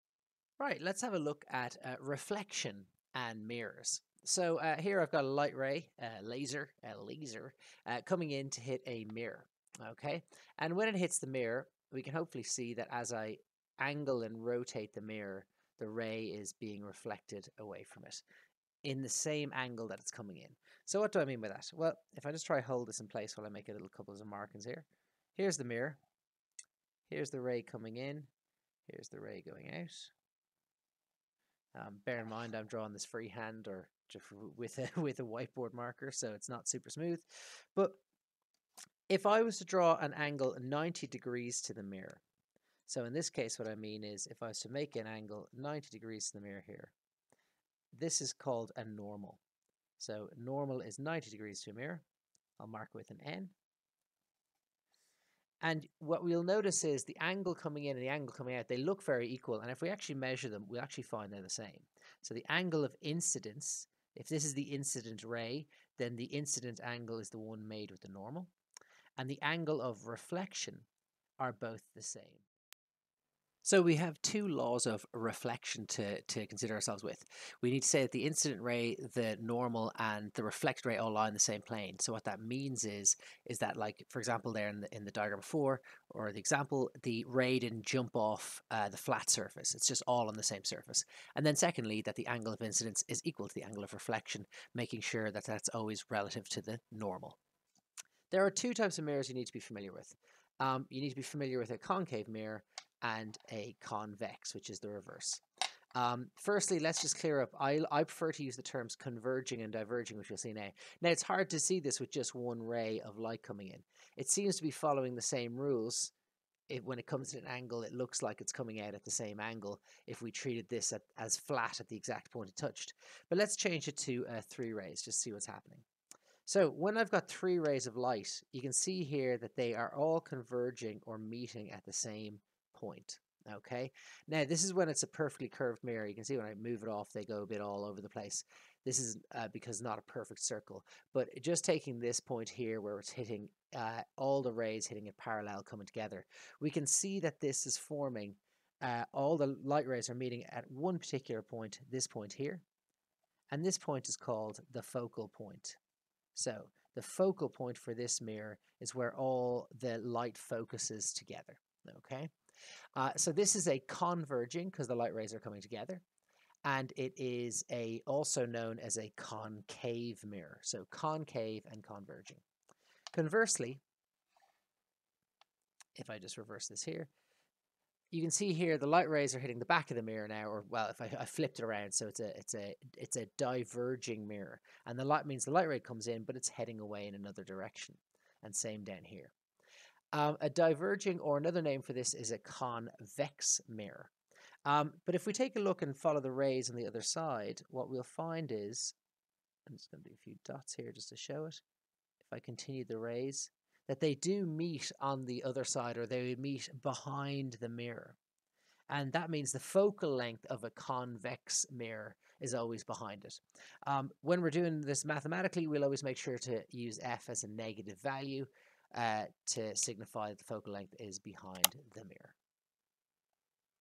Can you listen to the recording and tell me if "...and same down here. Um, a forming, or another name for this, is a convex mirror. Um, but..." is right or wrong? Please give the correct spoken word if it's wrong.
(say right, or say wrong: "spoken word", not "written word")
wrong: "diverging", not "forming".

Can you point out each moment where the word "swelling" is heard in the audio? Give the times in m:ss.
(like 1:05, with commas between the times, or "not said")
not said.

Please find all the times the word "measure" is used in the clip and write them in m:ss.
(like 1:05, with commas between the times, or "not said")
1:00.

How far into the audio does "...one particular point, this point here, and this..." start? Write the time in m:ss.
2:30.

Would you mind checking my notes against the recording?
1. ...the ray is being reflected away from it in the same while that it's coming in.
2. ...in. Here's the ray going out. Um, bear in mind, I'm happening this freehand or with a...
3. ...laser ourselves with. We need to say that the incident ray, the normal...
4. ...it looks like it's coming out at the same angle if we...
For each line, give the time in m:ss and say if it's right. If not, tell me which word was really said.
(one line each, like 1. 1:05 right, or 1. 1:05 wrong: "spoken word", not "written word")
1. 0:15 wrong: "angle", not "while"
2. 0:27 wrong: "drawing", not "happening"
3. 1:16 wrong: "consider", not "laser"
4. 1:57 right.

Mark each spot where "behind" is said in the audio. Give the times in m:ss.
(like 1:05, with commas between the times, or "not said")
3:26, 3:32, 3:41.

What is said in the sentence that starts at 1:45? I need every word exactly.
Um, firstly, let's just clear up.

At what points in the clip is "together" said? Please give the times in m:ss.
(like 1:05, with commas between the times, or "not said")
2:25, 2:41, 2:45.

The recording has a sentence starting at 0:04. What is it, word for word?
So uh, here I've got a light ray, a laser, a laser, uh, coming in to hit a mirror, okay?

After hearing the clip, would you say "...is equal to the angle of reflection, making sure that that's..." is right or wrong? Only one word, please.
right.